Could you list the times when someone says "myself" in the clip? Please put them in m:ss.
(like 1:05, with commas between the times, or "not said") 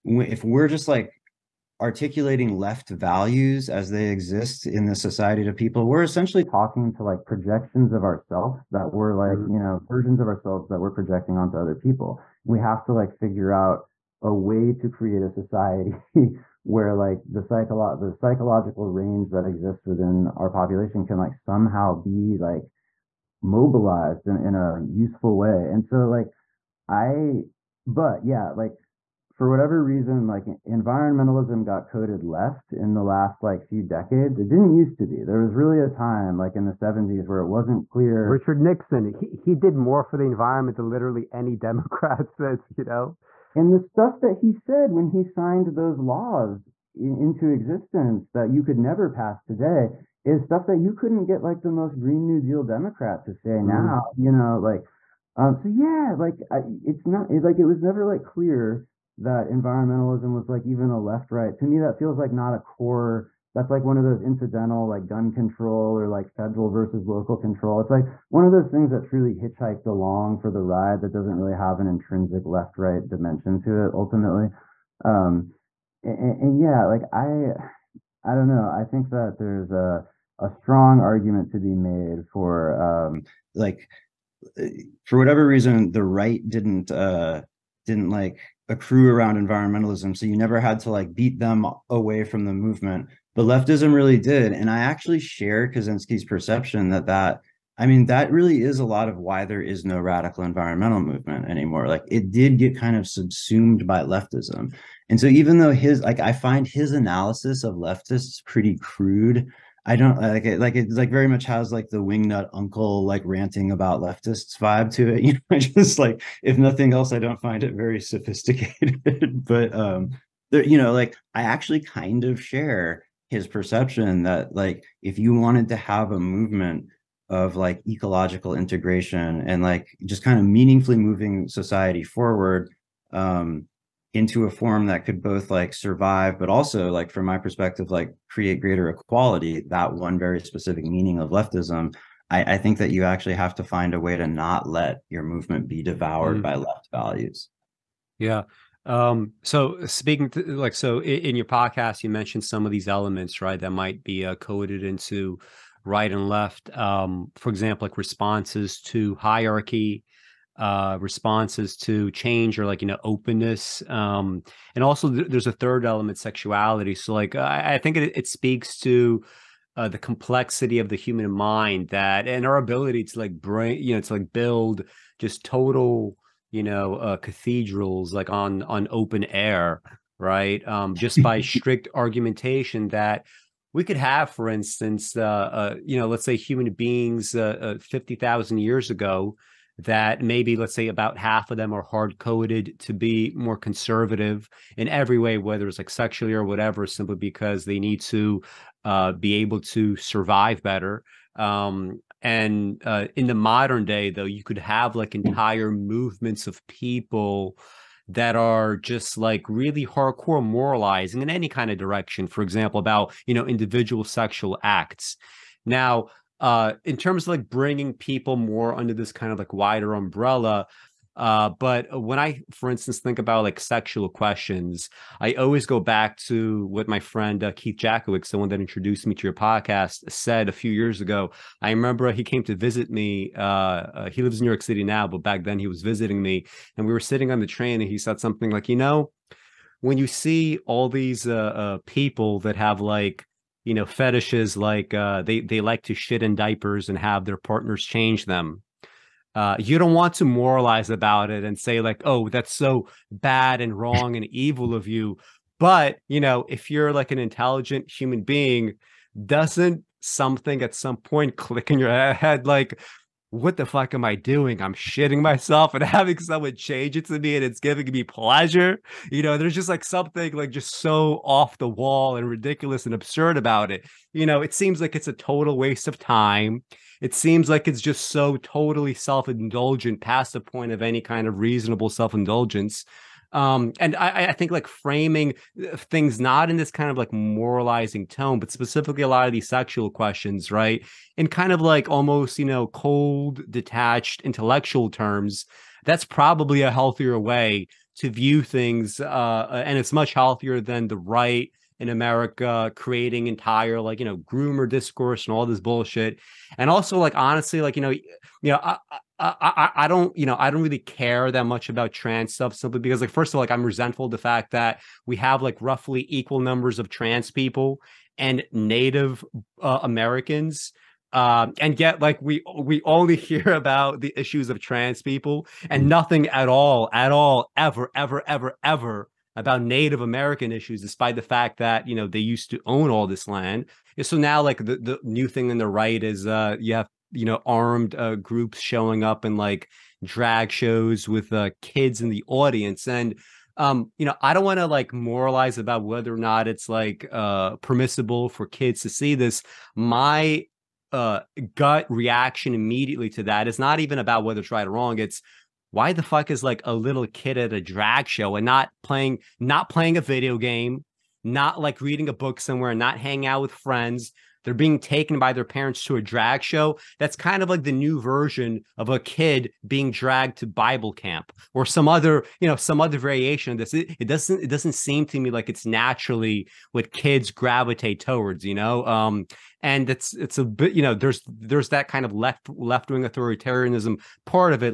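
4:25.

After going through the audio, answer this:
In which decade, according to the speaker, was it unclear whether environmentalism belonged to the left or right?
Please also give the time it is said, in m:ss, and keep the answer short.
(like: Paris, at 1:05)
the 70s, at 0:36.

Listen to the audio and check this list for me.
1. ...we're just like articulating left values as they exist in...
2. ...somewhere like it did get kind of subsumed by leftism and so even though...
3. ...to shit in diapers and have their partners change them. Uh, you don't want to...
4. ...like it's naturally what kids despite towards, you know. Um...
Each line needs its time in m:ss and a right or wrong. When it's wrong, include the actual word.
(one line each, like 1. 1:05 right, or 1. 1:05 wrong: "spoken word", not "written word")
1. 0:00 right
2. 1:41 wrong: "anymore", not "somewhere"
3. 4:05 right
4. 6:15 wrong: "gravitate", not "despite".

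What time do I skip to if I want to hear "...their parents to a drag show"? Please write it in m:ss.
6:05.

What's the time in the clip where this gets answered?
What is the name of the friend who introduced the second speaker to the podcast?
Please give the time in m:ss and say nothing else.
3:47.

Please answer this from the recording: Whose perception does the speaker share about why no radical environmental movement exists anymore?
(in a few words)
Kaczynski.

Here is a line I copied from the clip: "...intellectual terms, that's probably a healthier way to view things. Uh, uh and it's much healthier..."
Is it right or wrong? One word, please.
right.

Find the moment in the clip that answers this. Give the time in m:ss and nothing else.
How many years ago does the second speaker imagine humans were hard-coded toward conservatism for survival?
3:07.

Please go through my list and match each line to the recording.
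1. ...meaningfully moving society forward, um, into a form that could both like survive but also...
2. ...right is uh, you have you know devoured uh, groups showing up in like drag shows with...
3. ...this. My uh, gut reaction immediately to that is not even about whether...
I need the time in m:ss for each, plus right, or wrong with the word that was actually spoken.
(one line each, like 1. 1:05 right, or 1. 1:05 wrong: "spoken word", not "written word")
1. 2:10 right
2. 5:35 wrong: "armed", not "devoured"
3. 5:49 right.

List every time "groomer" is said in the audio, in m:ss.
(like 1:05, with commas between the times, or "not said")
5:04.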